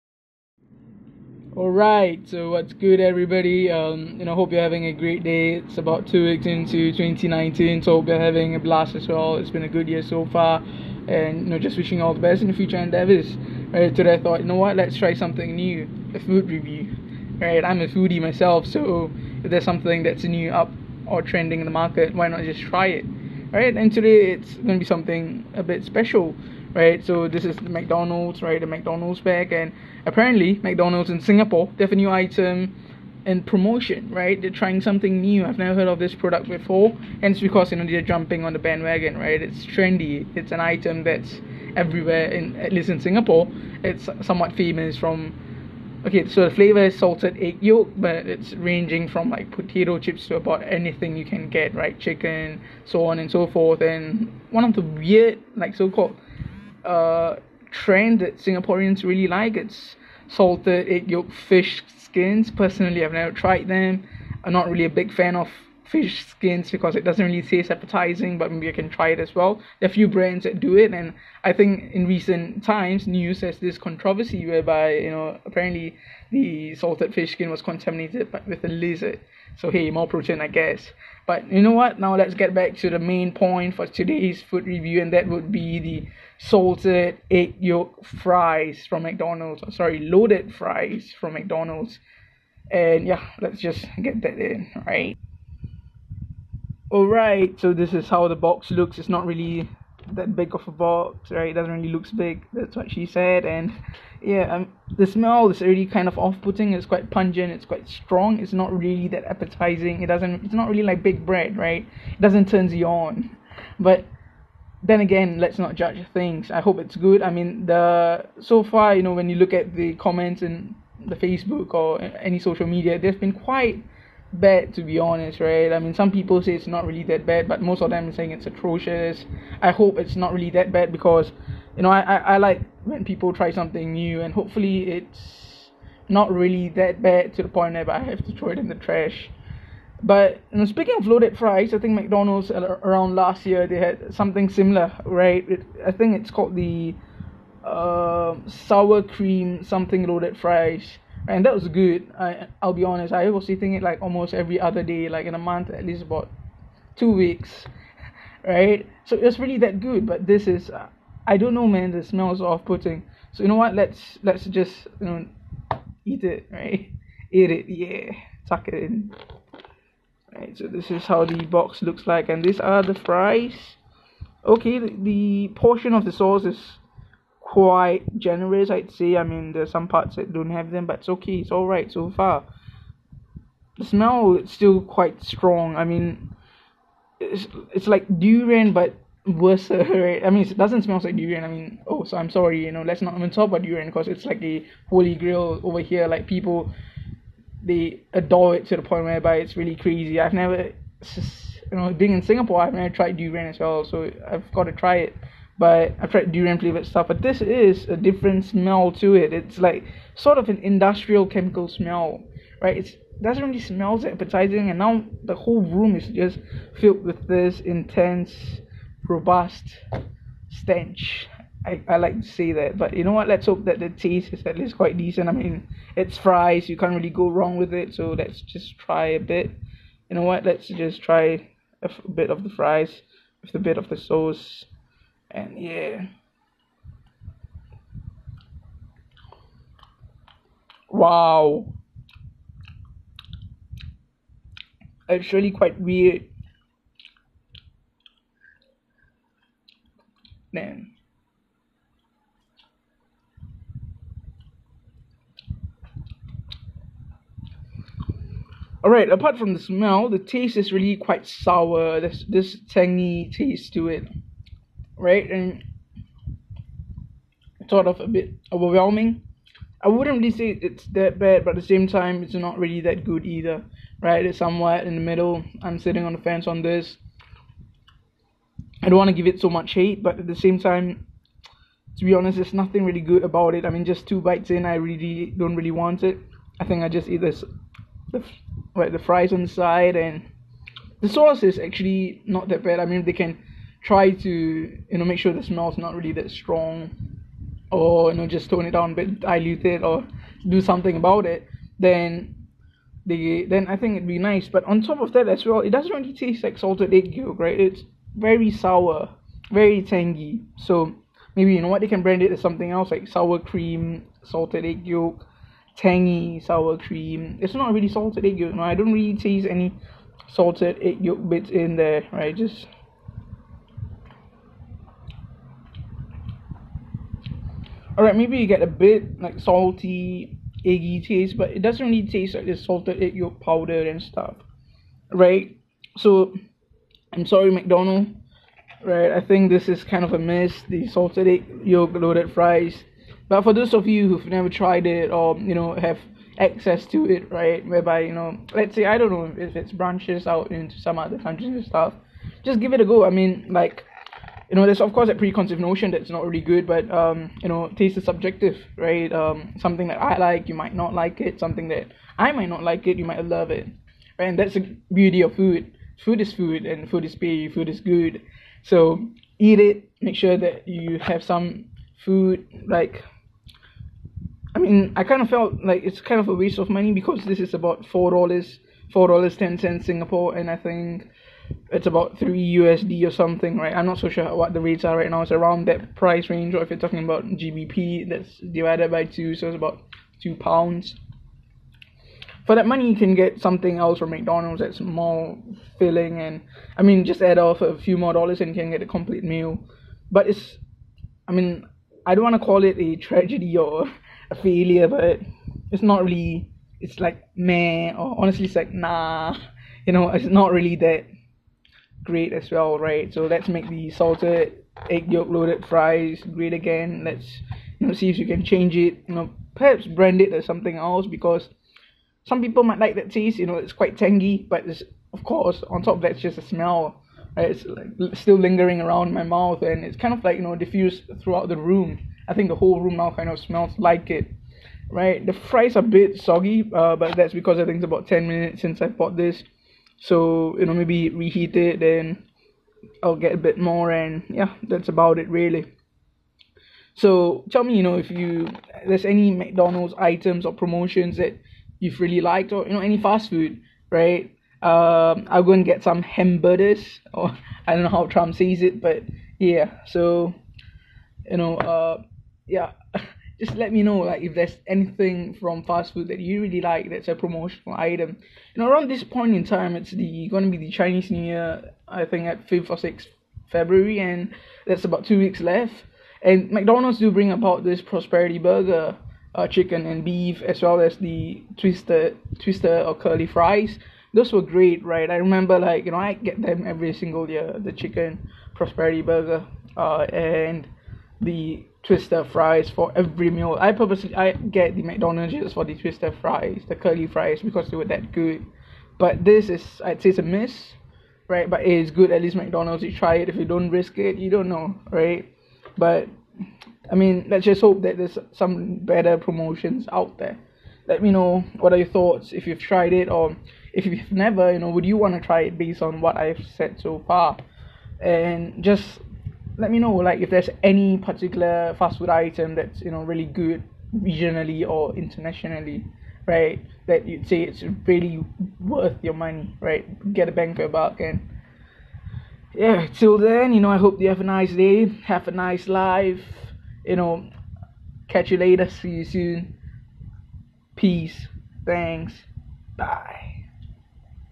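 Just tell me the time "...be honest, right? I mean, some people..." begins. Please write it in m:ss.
2:04.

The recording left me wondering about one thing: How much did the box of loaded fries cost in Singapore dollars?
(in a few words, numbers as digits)
$4.10.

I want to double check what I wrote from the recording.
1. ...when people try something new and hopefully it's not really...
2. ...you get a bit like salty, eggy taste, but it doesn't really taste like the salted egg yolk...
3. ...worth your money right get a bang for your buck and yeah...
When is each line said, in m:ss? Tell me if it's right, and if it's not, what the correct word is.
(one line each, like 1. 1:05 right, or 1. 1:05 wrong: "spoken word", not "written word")
1. 2:12 right
2. 5:28 right
3. 8:48 right.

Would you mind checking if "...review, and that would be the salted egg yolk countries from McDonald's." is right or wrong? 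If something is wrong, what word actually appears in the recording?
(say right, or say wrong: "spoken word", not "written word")
wrong: "fries", not "countries".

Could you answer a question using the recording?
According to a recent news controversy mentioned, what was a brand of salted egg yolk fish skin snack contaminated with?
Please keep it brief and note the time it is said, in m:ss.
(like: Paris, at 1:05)
A lizard, at 1:18.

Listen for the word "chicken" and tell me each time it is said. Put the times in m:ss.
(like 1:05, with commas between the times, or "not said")
0:51, 7:59, 8:07.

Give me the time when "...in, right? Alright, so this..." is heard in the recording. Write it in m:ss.
1:34.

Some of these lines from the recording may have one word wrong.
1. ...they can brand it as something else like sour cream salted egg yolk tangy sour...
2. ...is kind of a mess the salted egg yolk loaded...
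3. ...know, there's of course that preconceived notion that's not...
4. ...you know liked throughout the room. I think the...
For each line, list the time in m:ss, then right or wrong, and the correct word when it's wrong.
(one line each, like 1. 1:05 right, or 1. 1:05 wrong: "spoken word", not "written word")
1. 5:11 right
2. 5:39 right
3. 5:54 right
4. 7:10 wrong: "diffused", not "liked".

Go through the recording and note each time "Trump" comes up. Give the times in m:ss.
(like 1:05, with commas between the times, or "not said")
7:38.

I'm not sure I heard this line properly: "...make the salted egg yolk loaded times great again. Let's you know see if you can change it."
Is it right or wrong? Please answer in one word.
wrong.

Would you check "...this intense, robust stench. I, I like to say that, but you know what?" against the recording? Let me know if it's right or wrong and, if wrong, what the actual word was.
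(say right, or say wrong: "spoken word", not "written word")
right.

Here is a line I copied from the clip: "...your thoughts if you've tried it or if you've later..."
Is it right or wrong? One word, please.
wrong.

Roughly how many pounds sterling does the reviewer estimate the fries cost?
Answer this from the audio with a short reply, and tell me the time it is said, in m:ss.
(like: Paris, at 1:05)
2 pounds, at 6:30.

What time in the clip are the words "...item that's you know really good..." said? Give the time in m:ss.
8:42.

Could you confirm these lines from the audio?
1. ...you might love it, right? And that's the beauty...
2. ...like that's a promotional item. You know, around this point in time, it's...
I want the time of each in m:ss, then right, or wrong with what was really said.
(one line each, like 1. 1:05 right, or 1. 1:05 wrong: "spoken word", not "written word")
1. 6:02 right
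2. 7:46 right.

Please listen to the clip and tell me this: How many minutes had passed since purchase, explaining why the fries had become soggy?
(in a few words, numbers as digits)
10.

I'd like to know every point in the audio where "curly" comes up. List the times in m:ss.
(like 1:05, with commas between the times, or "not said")
8:02, 8:16.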